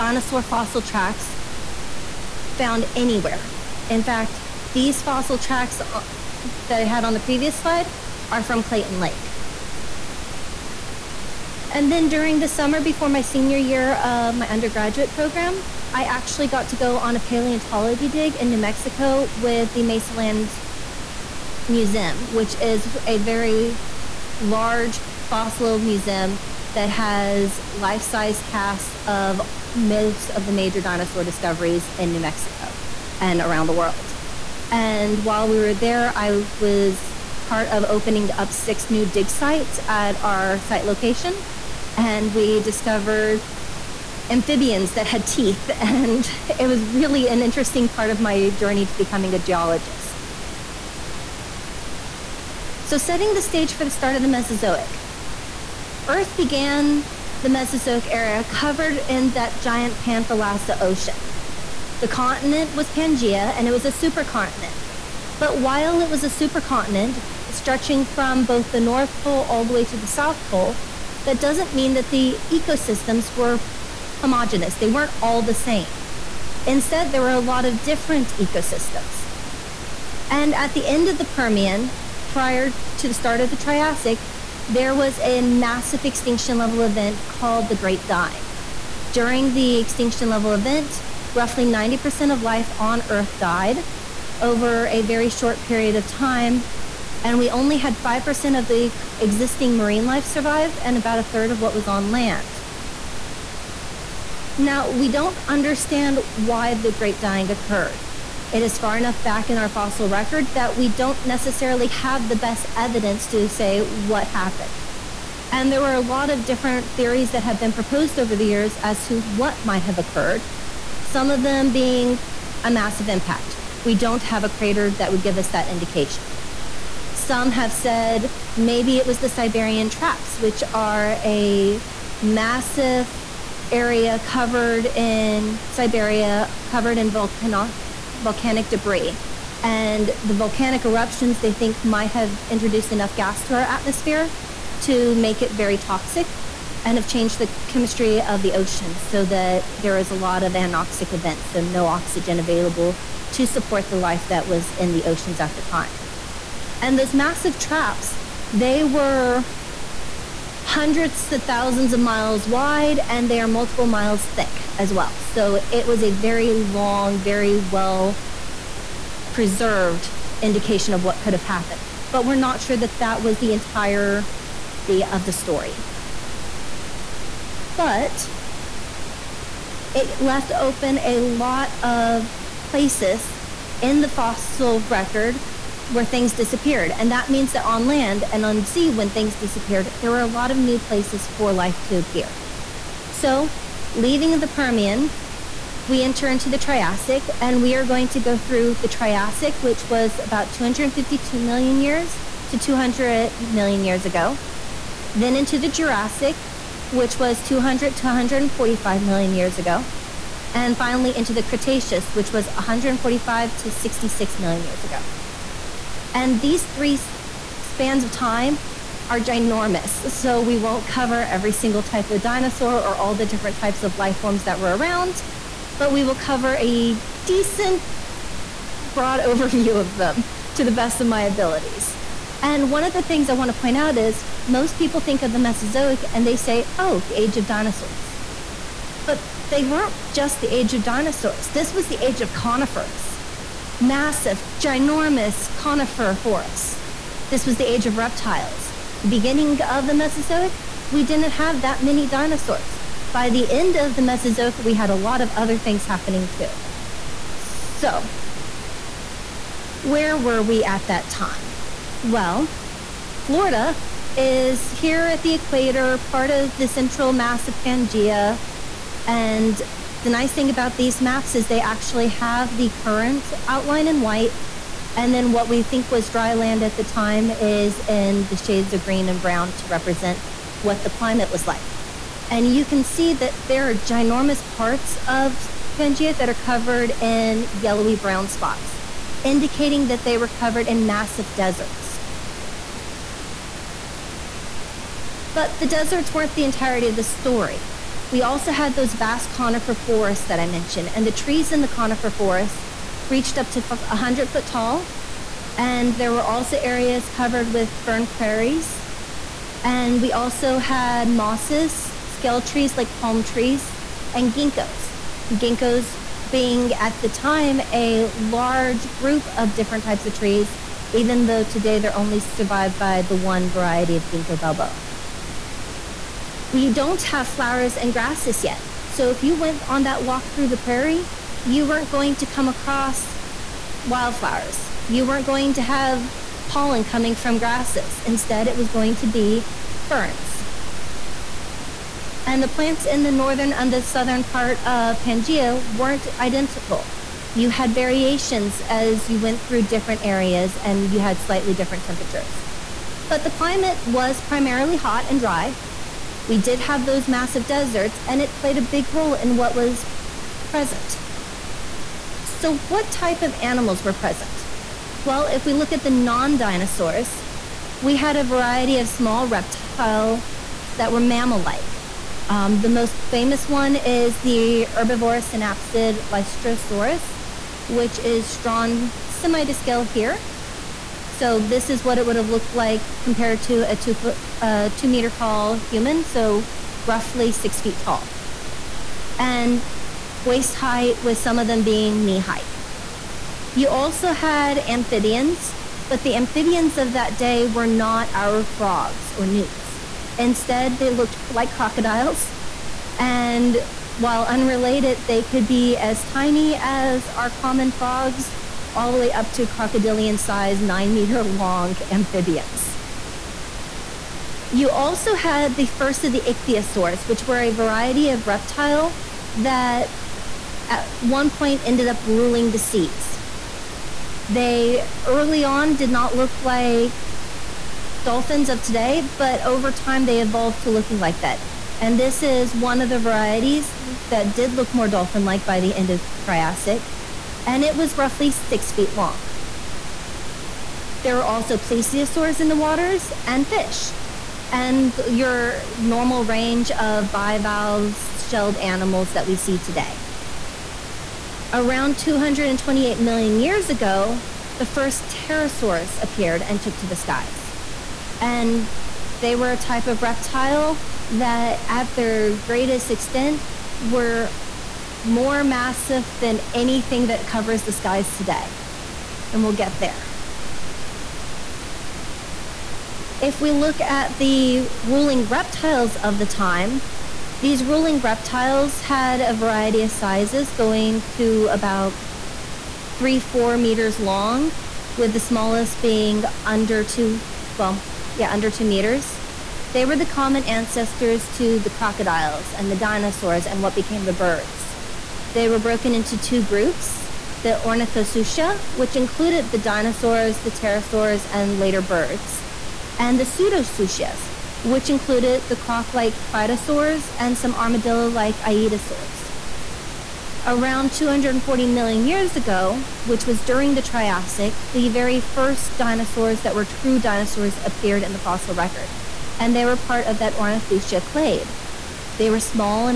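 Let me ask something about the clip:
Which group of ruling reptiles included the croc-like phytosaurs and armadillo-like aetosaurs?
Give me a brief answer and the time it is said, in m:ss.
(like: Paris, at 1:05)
pseudosuchias, at 8:23.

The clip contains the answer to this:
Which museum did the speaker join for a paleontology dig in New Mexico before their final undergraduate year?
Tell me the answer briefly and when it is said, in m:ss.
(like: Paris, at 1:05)
Mesaland Museum, at 0:19.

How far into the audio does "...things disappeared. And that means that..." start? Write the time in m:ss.
3:06.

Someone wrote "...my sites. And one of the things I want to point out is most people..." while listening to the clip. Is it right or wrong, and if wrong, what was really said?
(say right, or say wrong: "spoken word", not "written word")
wrong: "abilities", not "sites".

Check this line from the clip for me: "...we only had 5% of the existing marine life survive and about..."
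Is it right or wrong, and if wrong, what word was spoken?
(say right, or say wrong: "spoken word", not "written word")
right.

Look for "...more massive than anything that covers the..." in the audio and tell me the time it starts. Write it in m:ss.
7:45.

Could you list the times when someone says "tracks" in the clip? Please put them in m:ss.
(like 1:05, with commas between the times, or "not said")
0:00, 0:05.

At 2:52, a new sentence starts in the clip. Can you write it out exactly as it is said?
But we're not sure that that was the entirety of the story.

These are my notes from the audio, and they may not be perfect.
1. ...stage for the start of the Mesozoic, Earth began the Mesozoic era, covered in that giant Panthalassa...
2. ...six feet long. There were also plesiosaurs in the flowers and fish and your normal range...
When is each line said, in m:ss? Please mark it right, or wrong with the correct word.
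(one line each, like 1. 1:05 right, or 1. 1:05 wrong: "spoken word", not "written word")
1. 0:53 right
2. 7:18 wrong: "waters", not "flowers".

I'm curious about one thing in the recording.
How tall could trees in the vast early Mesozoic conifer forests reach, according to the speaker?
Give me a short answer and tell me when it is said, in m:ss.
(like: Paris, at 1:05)
100 feet, at 5:03.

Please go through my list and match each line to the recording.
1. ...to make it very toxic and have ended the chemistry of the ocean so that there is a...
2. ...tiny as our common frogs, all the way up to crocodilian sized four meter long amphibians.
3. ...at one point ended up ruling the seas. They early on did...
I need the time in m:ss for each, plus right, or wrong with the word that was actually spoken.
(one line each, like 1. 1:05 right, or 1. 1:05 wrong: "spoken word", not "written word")
1. 2:24 wrong: "changed", not "ended"
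2. 6:46 wrong: "nine", not "four"
3. 7:00 right.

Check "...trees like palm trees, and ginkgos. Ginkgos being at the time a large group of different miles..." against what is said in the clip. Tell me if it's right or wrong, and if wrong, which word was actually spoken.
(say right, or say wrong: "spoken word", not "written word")
wrong: "types", not "miles".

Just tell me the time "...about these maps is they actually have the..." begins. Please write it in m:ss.
4:30.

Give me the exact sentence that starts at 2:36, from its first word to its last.
And those massive traps, they were hundreds to thousands of miles wide and they are multiple miles thick as well.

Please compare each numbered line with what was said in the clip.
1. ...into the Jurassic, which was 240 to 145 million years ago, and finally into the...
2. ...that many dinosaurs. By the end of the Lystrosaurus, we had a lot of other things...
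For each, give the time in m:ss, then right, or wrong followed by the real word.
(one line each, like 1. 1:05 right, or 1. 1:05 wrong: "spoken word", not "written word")
1. 3:25 wrong: "200", not "240"
2. 4:11 wrong: "Mesozoic", not "Lystrosaurus".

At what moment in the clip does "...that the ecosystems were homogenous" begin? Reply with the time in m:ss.
1:11.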